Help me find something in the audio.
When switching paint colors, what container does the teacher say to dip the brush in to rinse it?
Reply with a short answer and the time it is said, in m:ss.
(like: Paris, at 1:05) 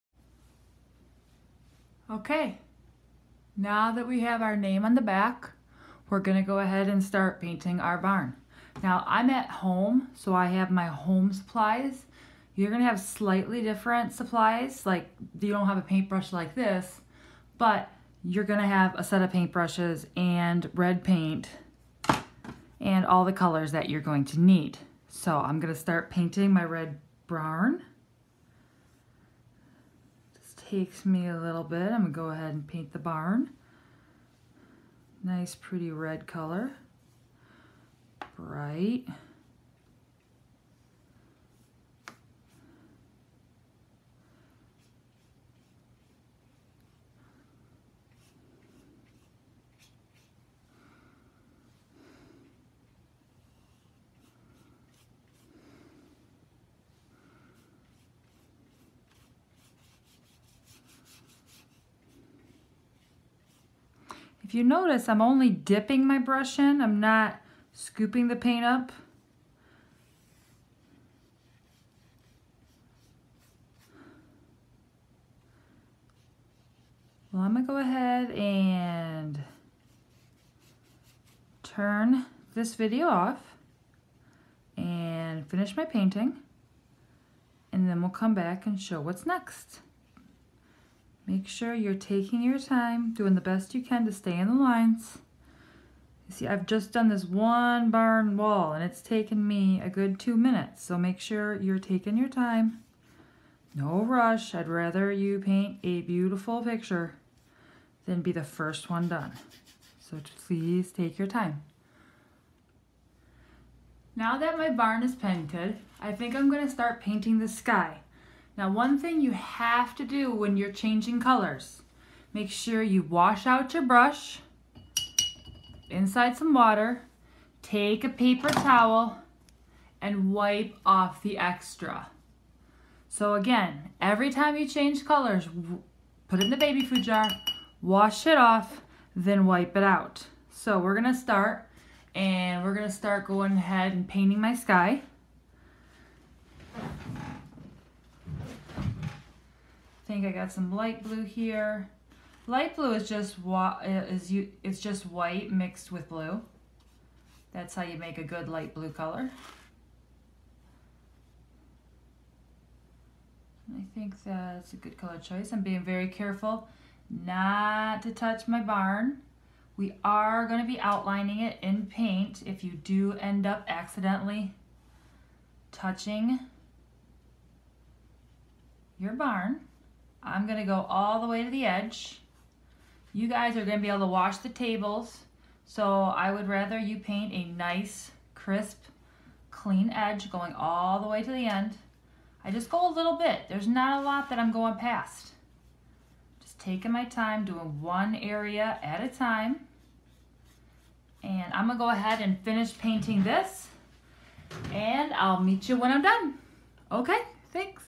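baby food jar, at 2:16.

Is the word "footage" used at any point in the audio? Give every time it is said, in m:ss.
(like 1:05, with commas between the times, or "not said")
not said.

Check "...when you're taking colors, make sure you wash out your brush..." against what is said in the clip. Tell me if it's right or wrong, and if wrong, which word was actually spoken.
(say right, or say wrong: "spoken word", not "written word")
wrong: "changing", not "taking".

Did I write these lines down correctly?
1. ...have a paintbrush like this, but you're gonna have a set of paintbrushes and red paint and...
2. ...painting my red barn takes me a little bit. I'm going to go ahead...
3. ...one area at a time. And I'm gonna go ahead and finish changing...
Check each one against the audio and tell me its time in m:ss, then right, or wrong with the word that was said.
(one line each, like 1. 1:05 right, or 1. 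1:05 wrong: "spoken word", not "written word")
1. 0:15 right
2. 0:26 right
3. 3:17 wrong: "painting", not "changing".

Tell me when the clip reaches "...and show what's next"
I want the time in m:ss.
1:28.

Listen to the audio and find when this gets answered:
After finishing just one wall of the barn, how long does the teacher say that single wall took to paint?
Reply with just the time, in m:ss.
1:40.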